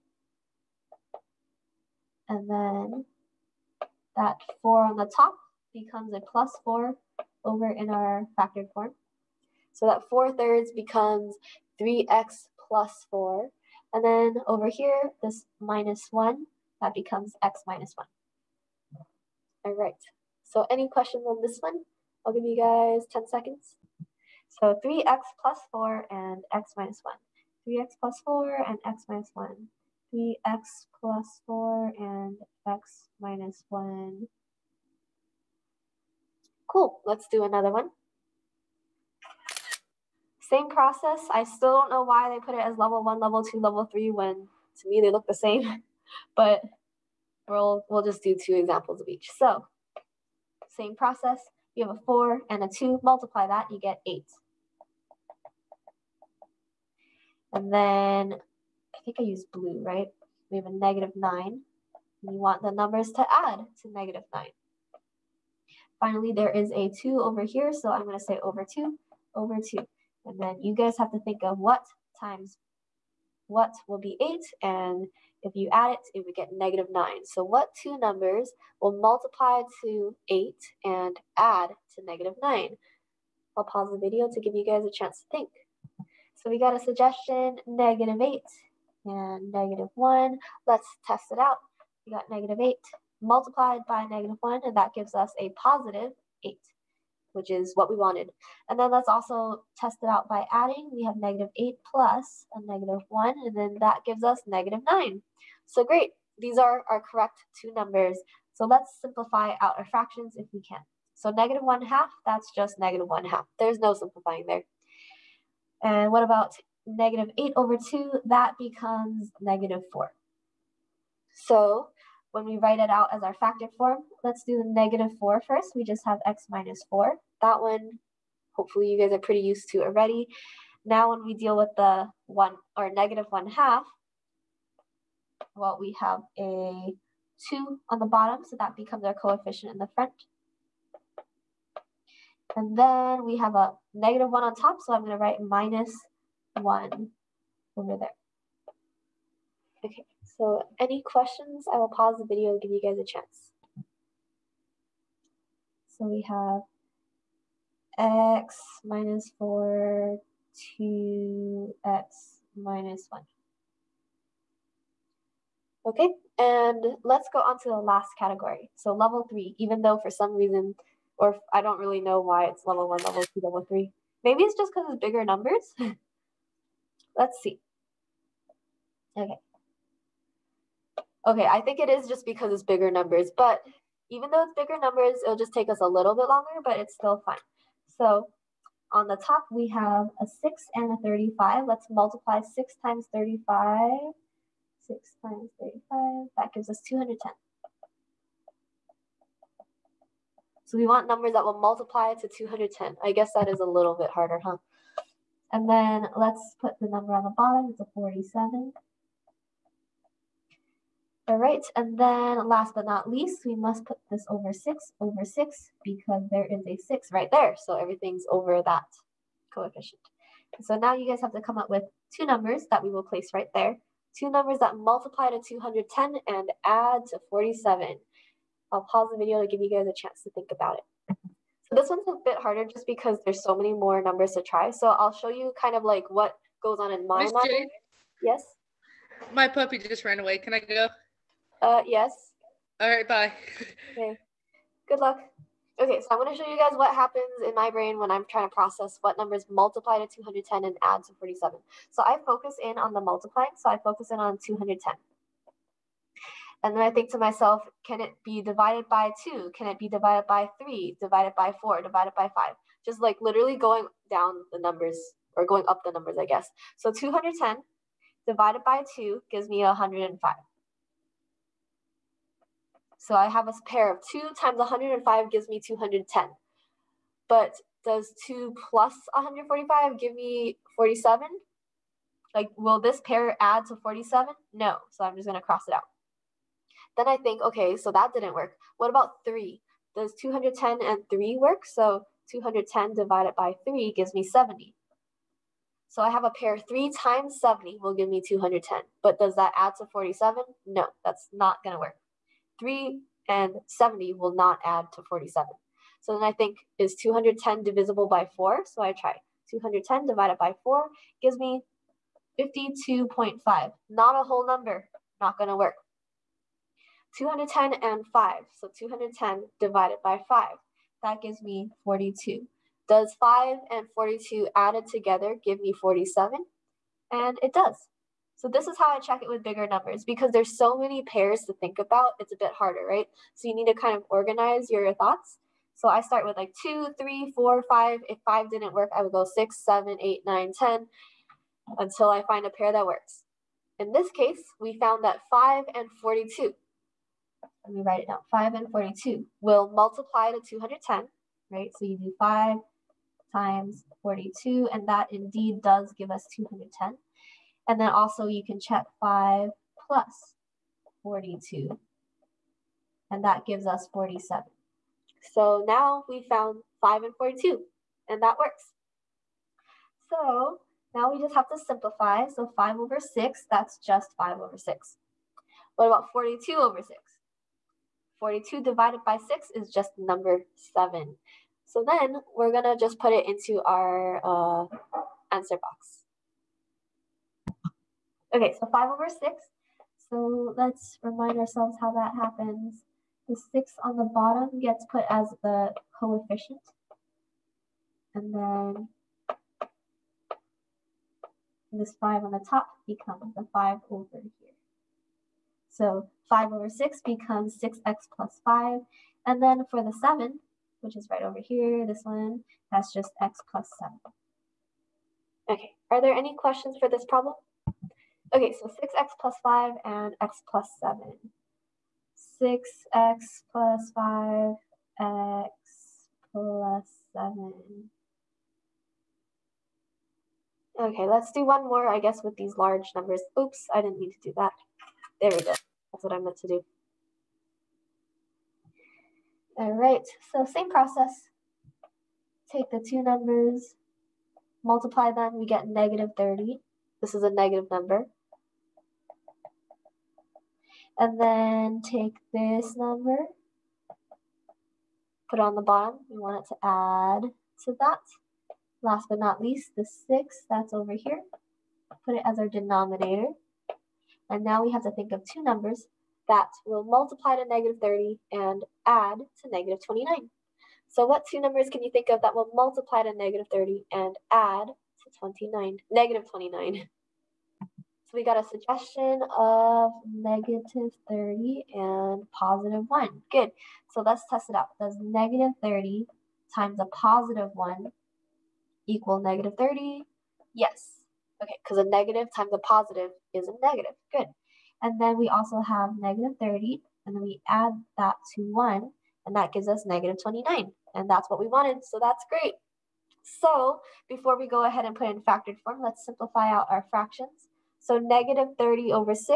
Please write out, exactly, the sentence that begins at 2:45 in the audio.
Okay, and let's go on to the last category.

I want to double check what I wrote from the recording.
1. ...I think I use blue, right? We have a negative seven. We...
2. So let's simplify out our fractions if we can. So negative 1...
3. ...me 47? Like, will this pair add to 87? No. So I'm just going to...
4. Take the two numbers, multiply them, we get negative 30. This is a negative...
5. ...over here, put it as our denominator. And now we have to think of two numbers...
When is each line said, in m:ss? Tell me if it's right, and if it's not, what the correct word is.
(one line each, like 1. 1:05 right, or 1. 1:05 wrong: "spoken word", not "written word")
1. 0:58 wrong: "nine", not "seven"
2. 1:48 right
3. 4:40 wrong: "47", not "87"
4. 7:22 right
5. 7:40 right.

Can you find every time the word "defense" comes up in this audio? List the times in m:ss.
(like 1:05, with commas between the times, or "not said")
not said.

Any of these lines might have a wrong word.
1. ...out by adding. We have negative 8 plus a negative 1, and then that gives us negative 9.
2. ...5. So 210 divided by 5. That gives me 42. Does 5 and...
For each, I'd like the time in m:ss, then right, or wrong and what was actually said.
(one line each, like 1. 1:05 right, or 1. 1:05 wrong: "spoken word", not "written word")
1. 1:40 right
2. 5:18 right.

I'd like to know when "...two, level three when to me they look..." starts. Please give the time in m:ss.
0:43.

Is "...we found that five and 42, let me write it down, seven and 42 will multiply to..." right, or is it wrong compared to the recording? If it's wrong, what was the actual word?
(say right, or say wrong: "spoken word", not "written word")
wrong: "five", not "seven".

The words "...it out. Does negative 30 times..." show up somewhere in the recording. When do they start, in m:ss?
8:04.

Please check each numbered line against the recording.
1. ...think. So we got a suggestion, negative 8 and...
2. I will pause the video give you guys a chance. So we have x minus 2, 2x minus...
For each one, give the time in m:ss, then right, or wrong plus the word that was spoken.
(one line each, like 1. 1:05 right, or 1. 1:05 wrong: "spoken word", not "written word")
1. 1:25 right
2. 2:31 wrong: "4", not "2".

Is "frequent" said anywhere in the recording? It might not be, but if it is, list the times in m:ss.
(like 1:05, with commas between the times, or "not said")
not said.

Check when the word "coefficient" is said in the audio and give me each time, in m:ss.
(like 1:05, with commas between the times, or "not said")
2:19, 3:39, 6:35.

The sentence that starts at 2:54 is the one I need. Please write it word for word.
Maybe it's just because it's bigger numbers.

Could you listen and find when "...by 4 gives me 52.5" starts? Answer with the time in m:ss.
5:10.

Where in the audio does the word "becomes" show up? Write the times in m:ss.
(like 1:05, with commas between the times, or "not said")
0:05, 0:10, 0:16, 1:58, 2:18, 6:42, 6:47.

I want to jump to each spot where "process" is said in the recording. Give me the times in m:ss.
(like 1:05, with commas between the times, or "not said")
0:40, 0:50, 4:08, 7:20.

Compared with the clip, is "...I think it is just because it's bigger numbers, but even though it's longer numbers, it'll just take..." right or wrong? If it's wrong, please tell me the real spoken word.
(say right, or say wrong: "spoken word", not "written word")
wrong: "bigger", not "longer".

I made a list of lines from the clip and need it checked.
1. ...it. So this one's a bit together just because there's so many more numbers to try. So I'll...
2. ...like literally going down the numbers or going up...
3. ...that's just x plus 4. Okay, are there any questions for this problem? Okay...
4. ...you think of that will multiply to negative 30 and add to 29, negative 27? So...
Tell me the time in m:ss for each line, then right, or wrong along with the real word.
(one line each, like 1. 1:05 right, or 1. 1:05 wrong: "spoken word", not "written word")
1. 3:50 wrong: "harder", not "together"
2. 4:23 right
3. 6:52 wrong: "7", not "4"
4. 7:51 wrong: "29", not "27".